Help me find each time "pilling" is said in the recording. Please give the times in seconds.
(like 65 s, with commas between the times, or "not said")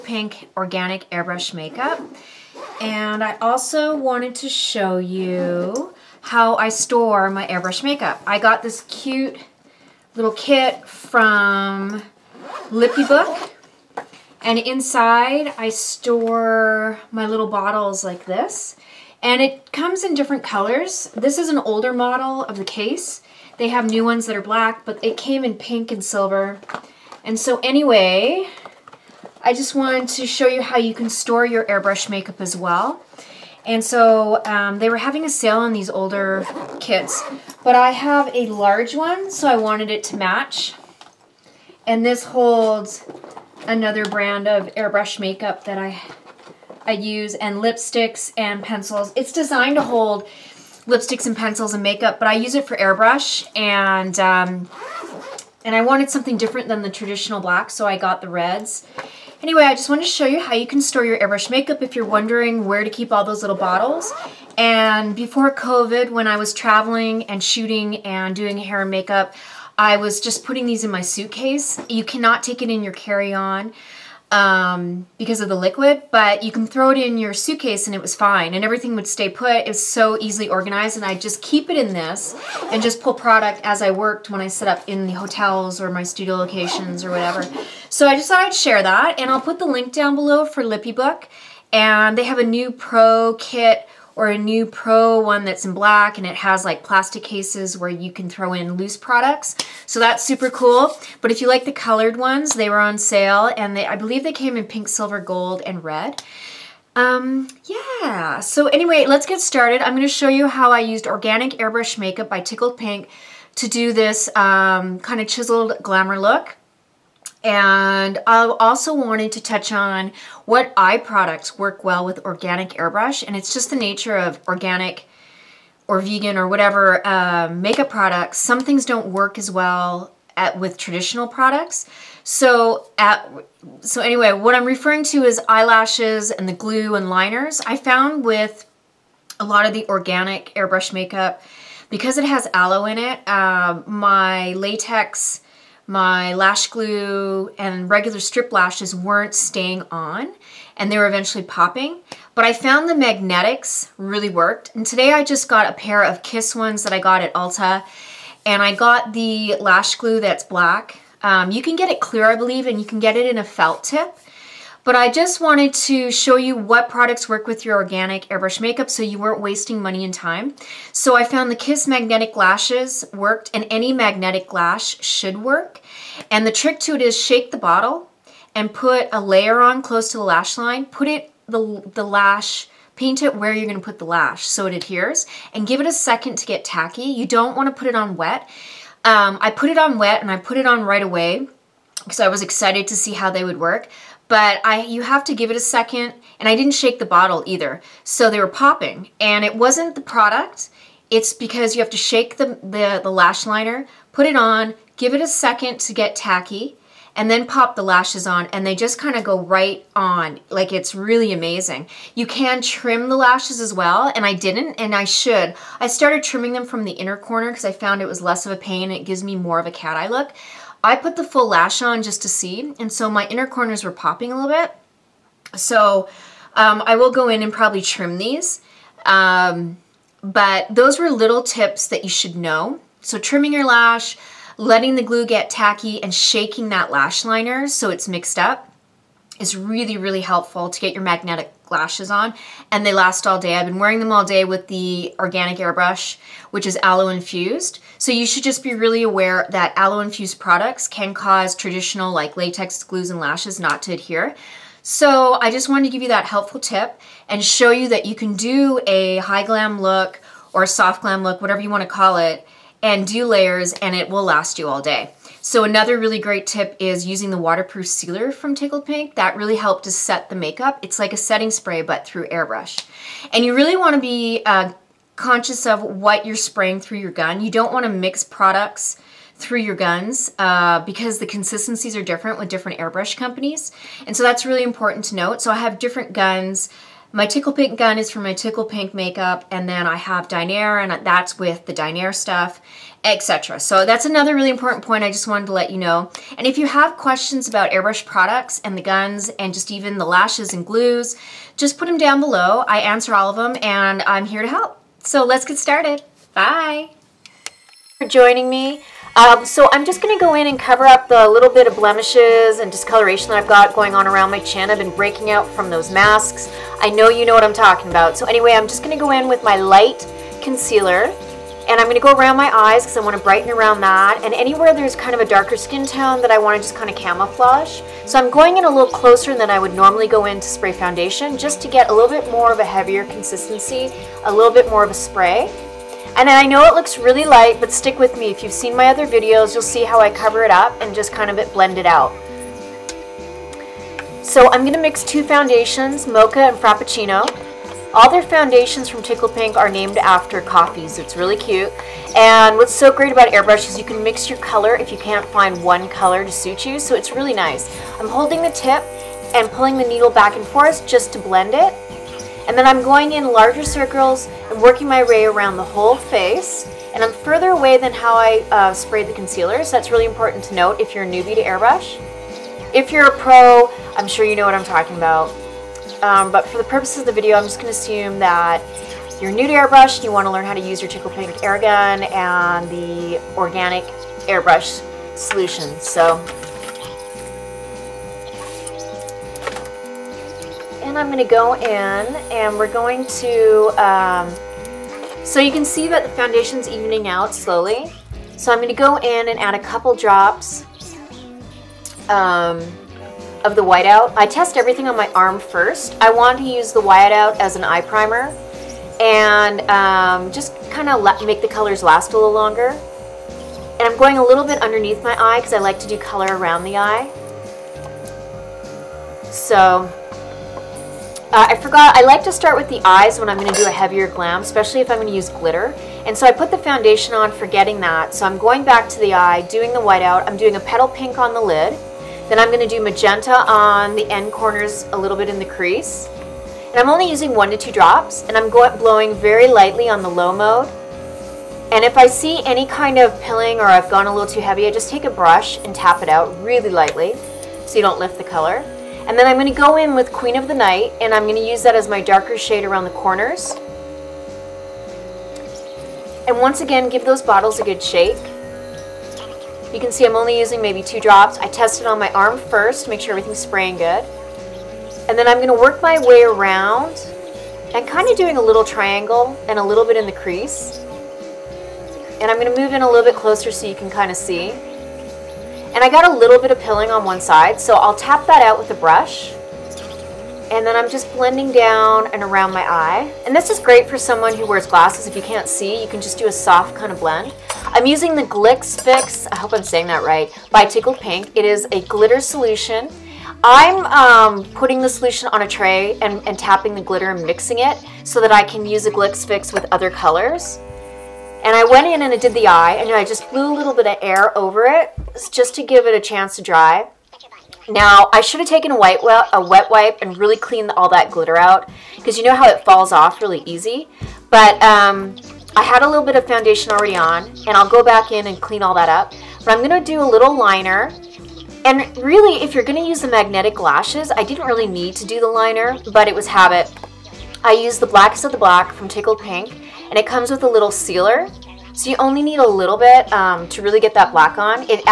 443 s, 476 s.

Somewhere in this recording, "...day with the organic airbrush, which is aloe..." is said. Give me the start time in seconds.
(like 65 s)
244 s.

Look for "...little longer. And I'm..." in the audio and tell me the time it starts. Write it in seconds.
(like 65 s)
412 s.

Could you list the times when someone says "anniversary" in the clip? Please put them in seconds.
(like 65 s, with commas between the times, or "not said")
not said.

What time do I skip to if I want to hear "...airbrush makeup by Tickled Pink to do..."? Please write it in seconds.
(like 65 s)
111 s.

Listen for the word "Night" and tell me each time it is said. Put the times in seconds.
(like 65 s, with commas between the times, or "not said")
450 s.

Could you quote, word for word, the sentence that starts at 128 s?
Some things don't work as well at, with traditional products.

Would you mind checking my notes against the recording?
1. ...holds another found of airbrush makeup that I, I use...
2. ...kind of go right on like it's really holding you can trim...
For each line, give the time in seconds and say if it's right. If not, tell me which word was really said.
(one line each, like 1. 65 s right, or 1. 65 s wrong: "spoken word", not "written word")
1. 42 s wrong: "brand", not "found"
2. 208 s wrong: "amazing", not "holding".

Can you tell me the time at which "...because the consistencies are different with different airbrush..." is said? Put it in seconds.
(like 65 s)
280 s.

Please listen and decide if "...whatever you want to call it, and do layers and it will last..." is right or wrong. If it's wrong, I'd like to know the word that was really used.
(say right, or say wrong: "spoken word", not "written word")
right.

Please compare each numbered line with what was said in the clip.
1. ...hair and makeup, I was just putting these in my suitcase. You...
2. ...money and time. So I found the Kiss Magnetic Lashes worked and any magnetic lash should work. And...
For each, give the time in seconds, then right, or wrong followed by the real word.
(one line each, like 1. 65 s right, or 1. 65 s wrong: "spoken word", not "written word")
1. 68 s right
2. 169 s right.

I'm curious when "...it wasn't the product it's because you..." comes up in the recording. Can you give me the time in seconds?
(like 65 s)
199 s.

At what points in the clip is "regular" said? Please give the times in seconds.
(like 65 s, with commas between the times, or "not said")
147 s.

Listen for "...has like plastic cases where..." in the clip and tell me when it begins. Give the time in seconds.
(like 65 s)
96 s.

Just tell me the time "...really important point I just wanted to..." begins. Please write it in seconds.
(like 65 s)
294 s.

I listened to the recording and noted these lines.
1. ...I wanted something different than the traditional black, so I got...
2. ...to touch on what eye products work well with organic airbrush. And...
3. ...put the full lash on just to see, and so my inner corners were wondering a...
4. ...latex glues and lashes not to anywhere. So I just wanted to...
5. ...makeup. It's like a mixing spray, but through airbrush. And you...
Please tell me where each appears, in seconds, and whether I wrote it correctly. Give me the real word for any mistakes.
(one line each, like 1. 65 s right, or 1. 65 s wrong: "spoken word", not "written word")
1. 55 s right
2. 119 s right
3. 220 s wrong: "popping", not "wondering"
4. 252 s wrong: "adhere", not "anywhere"
5. 270 s wrong: "setting", not "mixing".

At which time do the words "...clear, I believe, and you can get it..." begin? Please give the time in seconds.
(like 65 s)
161 s.